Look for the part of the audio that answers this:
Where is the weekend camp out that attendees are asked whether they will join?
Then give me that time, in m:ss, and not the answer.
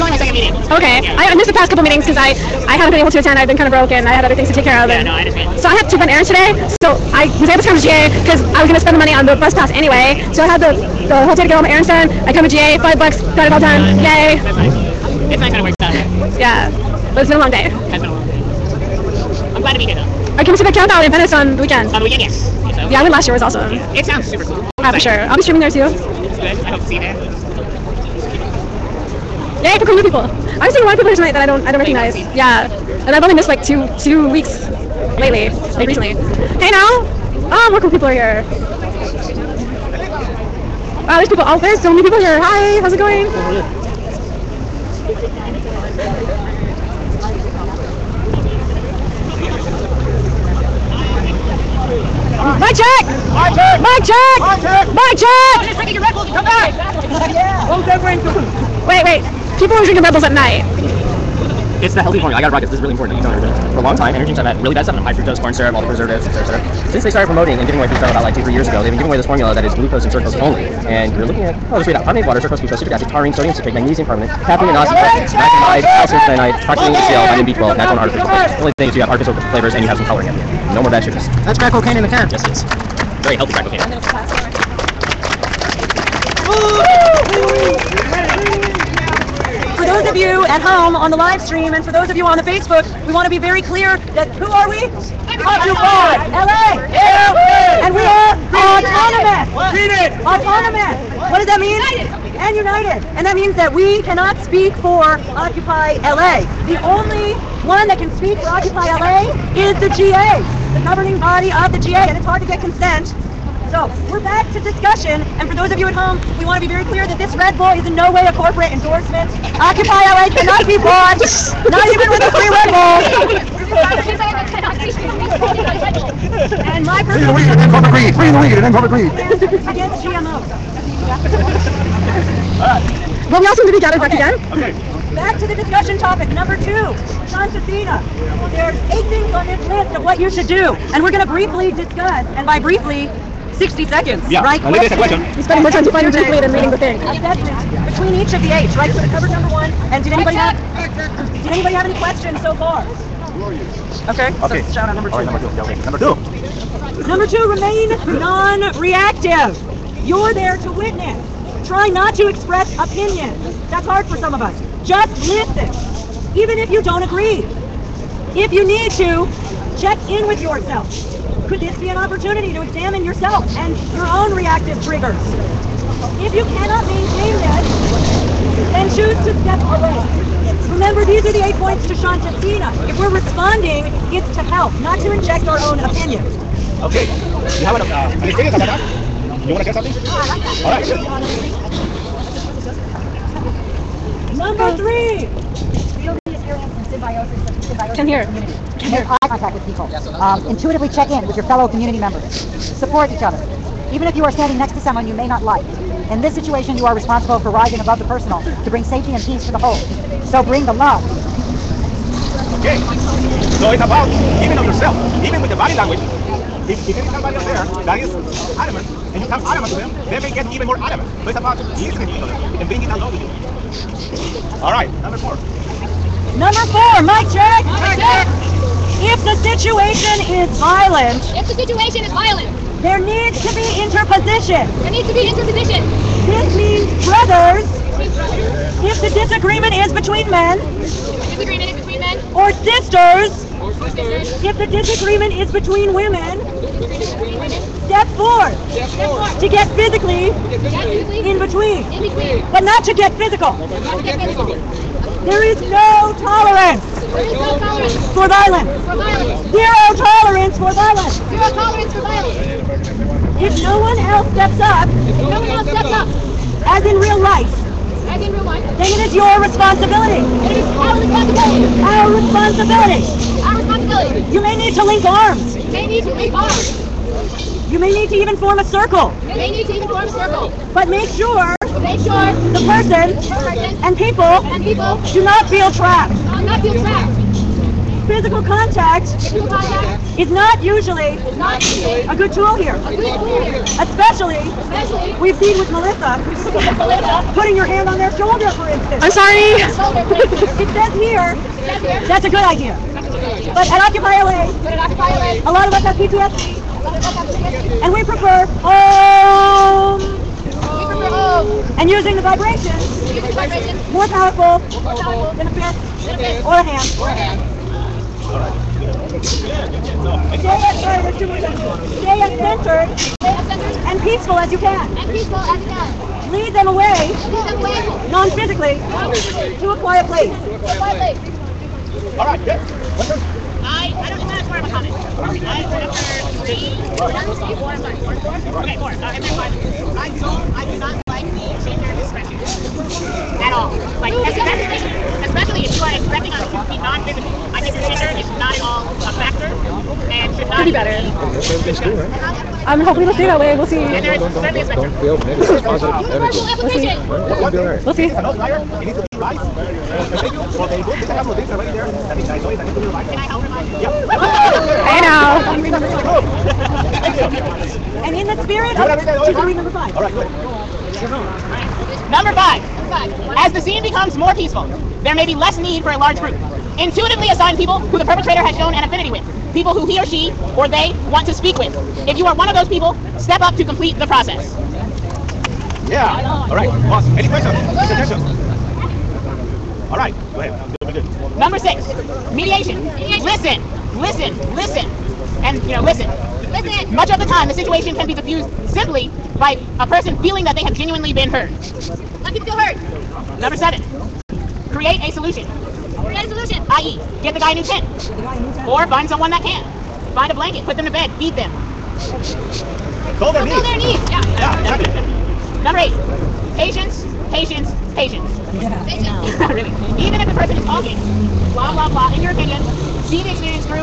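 0:21.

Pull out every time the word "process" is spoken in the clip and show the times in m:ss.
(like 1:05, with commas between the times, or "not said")
6:24.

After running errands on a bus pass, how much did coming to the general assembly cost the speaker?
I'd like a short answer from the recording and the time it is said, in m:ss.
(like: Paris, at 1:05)
5 bucks, at 0:12.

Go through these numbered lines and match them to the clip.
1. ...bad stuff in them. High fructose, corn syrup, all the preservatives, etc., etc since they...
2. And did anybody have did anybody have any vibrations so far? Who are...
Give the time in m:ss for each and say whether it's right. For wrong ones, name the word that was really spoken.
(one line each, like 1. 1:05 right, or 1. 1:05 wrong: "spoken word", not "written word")
1. 1:04 right
2. 2:29 wrong: "questions", not "vibrations".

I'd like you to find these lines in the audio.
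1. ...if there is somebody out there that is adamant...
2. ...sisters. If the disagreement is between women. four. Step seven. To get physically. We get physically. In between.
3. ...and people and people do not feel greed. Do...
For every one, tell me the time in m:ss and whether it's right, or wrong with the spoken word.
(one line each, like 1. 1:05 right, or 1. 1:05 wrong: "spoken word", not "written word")
1. 3:36 right
2. 4:03 wrong: "four", not "seven"
3. 4:43 wrong: "trapped", not "greed".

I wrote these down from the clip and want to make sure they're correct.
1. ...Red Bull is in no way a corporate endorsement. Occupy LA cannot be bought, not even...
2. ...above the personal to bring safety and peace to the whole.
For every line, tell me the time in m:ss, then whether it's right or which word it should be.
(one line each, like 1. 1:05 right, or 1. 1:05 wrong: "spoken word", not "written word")
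1. 1:57 right
2. 3:27 right.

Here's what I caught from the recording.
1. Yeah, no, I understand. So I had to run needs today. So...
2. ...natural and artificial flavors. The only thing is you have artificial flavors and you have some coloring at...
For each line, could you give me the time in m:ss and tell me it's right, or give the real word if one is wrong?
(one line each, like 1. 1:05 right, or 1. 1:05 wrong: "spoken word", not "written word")
1. 0:04 wrong: "errands", not "needs"
2. 1:17 right.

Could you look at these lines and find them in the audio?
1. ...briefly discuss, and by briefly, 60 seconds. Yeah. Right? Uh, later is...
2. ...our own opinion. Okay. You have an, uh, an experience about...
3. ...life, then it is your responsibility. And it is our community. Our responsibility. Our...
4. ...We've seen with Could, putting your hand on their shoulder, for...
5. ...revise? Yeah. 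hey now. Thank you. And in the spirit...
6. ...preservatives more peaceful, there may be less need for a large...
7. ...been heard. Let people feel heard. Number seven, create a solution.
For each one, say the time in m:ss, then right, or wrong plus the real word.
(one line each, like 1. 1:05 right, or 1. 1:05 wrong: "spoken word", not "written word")
1. 2:21 right
2. 3:05 right
3. 4:28 wrong: "responsibility", not "community"
4. 4:55 wrong: "Melissa", not "Could"
5. 6:03 right
6. 6:13 wrong: "becomes", not "preservatives"
7. 6:41 right.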